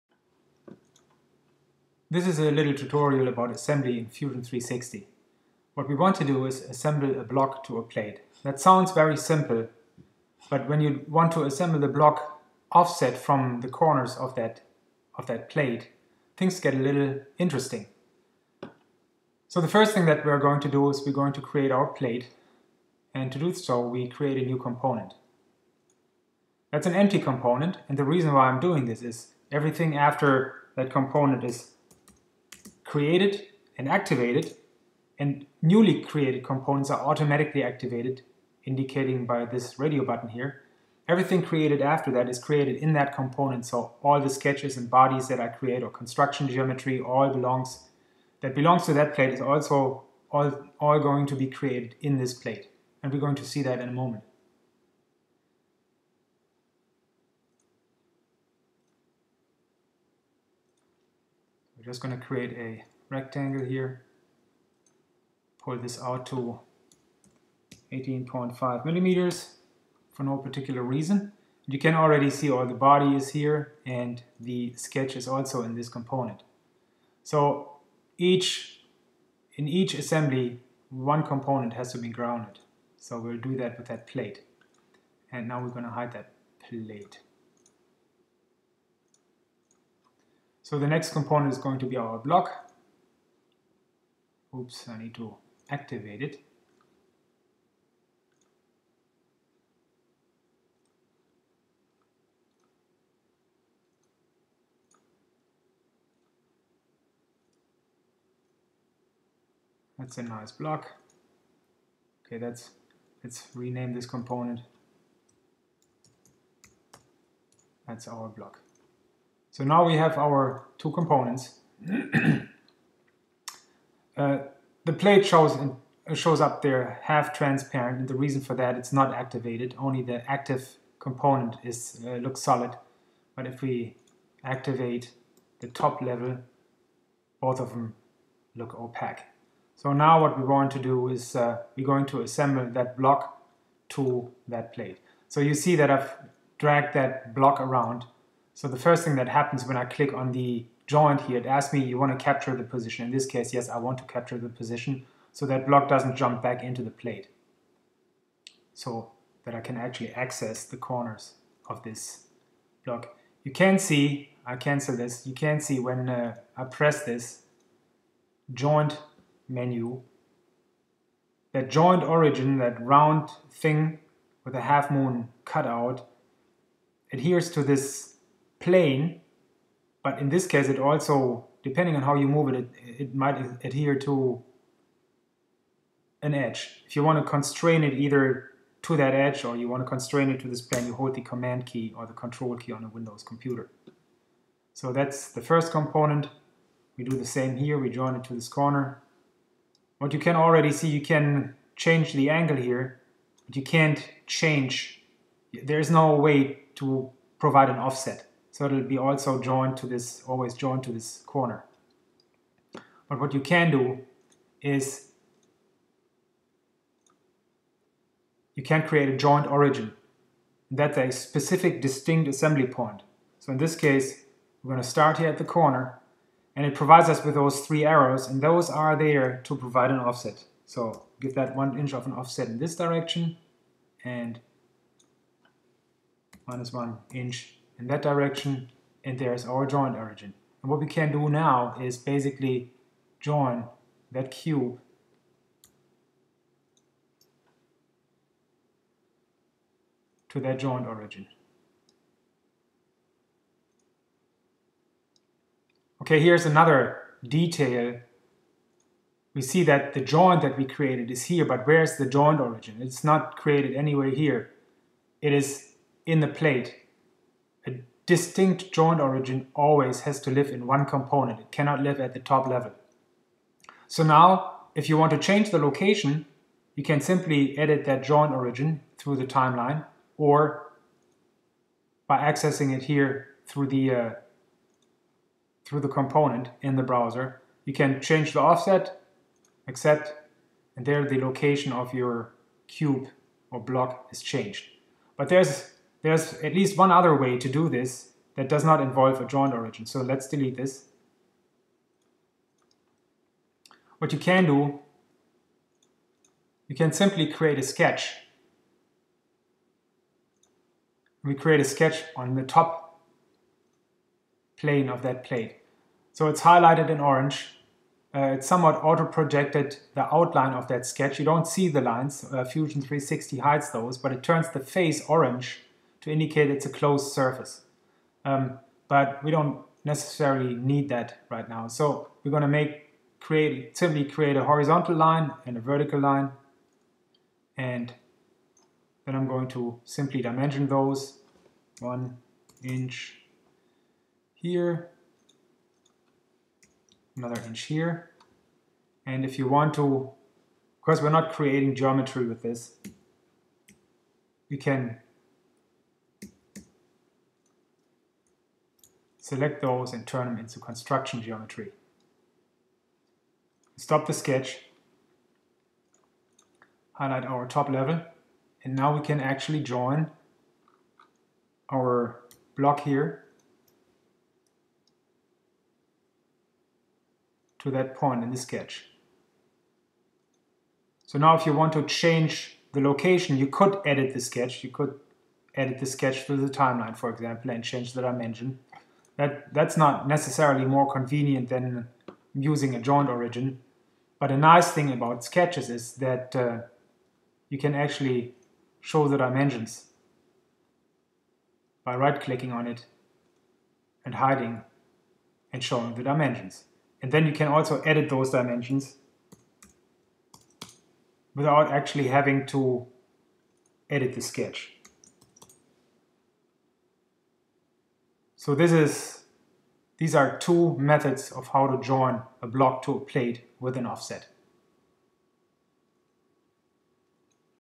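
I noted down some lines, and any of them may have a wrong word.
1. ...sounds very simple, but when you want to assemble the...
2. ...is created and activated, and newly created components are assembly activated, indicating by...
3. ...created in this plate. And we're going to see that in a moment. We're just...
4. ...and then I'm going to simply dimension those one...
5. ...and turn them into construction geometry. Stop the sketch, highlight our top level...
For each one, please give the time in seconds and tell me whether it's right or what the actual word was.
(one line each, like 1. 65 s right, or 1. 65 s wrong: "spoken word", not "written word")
1. 8 s right
2. 31 s wrong: "automatically", not "assembly"
3. 51 s right
4. 337 s right
5. 359 s right.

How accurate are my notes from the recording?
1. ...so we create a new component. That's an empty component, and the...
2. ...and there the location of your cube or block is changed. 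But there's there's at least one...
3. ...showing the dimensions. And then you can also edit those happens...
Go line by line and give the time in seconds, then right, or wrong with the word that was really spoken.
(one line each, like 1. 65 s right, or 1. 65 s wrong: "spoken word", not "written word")
1. 23 s right
2. 290 s right
3. 405 s wrong: "dimensions", not "happens".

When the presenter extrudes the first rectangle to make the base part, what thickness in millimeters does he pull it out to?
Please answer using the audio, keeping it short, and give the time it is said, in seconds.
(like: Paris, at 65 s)
18.5 millimeters, at 67 s.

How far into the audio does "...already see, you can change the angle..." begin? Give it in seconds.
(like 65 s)
200 s.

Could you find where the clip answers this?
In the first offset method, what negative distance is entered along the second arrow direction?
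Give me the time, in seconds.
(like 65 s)
236 s.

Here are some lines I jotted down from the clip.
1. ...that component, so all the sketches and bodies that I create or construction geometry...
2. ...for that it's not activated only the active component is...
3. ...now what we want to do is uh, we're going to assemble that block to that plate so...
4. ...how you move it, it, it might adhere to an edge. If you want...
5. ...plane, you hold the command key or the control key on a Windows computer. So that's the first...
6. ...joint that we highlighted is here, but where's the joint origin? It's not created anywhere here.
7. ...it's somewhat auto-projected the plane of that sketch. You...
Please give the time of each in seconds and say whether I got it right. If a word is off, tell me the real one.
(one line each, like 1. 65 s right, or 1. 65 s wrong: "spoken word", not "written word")
1. 42 s right
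2. 128 s right
3. 139 s right
4. 182 s right
5. 190 s right
6. 260 s wrong: "created", not "highlighted"
7. 318 s wrong: "outline", not "plane".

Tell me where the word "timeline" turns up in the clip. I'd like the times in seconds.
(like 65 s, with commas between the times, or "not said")
279 s, 386 s.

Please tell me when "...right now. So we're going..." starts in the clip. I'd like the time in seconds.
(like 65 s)
331 s.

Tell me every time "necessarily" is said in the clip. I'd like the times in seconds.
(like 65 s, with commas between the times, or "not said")
329 s, 390 s.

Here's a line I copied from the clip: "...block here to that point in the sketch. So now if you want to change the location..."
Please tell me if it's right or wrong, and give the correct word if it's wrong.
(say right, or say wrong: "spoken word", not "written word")
right.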